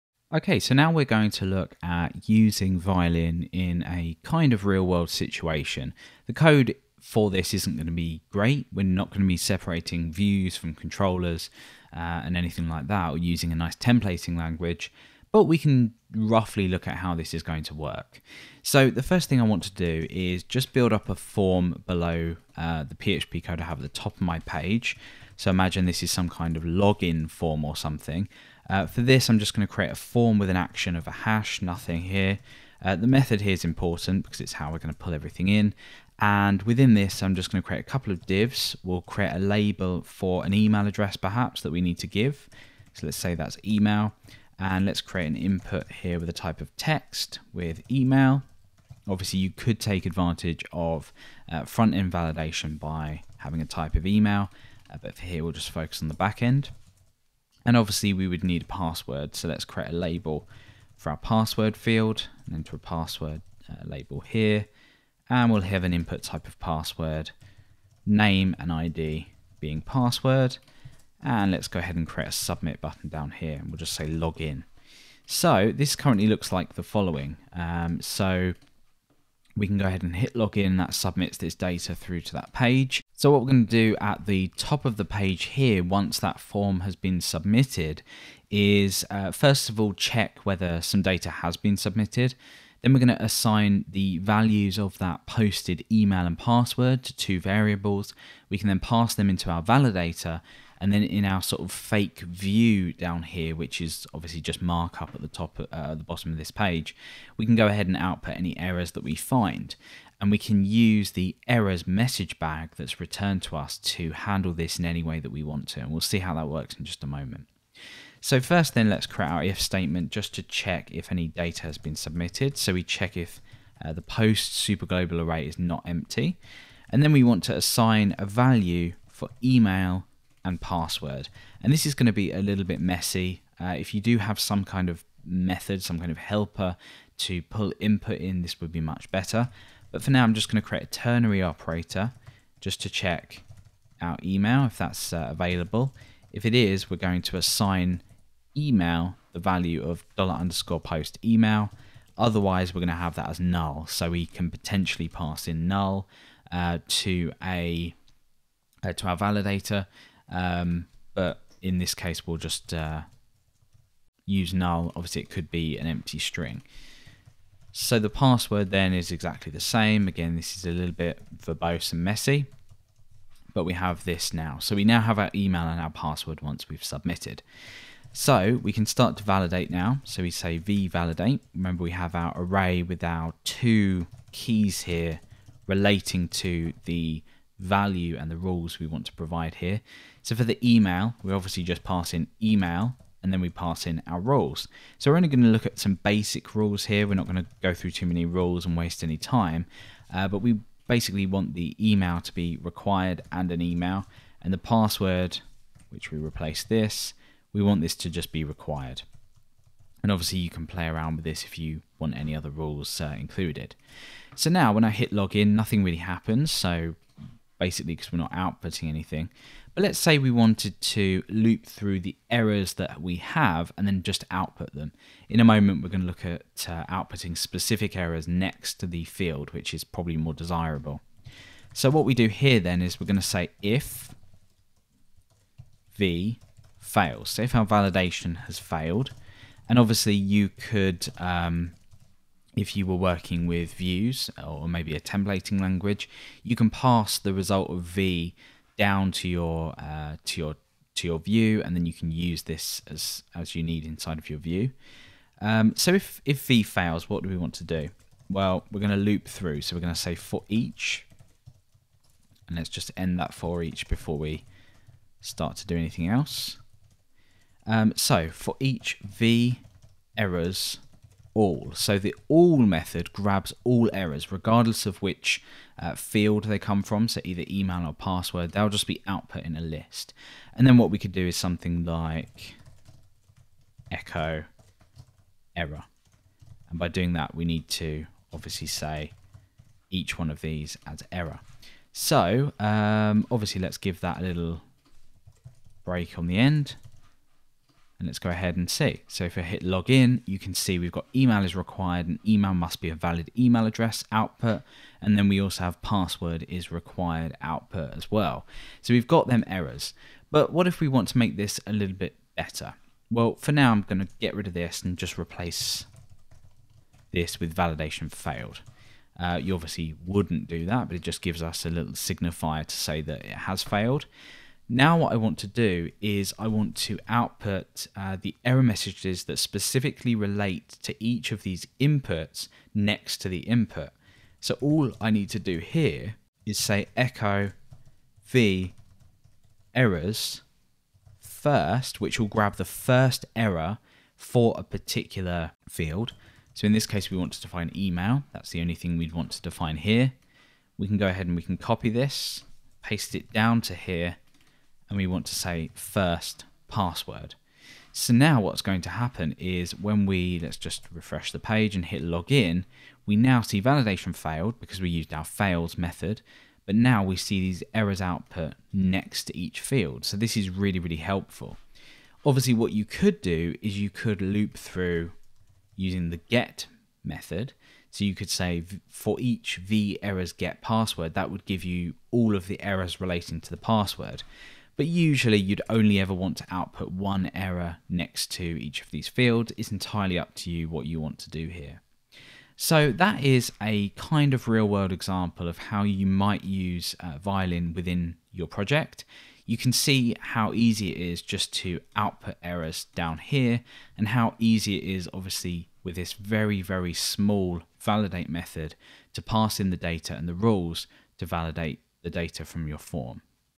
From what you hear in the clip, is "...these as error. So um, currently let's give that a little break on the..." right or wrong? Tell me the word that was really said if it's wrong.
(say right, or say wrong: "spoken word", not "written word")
wrong: "obviously", not "currently".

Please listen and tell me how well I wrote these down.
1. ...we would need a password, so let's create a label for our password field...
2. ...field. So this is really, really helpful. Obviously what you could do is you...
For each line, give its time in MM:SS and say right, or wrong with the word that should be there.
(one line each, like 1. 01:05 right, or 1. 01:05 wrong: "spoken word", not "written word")
1. 00:58 right
2. 06:09 right.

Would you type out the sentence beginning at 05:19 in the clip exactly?
Uh, you obviously wouldn't do that, but it just gives us a little signifier to say that it has failed.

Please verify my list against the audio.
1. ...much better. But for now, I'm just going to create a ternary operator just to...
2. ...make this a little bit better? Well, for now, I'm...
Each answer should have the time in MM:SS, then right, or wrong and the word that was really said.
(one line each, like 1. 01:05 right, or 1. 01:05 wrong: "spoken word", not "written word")
1. 02:18 right
2. 05:11 right.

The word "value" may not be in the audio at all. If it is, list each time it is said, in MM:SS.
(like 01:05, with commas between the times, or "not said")
01:34, 02:08, 02:29, 03:07.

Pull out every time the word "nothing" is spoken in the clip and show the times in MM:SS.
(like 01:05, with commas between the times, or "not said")
00:31, 03:35.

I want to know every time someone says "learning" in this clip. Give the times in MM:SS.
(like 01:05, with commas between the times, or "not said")
not said.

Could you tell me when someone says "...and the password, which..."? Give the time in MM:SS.
03:24.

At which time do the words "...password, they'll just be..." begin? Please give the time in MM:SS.
04:37.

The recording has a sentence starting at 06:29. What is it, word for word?
It's entirely up to you what you want to do here.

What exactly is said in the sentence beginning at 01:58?
So first then let's create our if statement just to check if any data has been submitted.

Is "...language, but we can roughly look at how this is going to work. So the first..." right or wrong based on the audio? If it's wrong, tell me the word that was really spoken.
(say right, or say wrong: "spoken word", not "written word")
right.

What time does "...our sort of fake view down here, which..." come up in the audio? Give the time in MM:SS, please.
01:41.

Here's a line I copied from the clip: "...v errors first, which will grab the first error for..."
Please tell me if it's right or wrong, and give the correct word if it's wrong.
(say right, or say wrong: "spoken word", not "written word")
right.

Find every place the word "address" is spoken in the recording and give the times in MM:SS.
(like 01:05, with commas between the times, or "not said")
00:40, 05:03.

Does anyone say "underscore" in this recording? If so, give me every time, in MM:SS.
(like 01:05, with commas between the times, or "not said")
02:30.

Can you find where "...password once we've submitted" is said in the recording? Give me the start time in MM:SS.
02:55.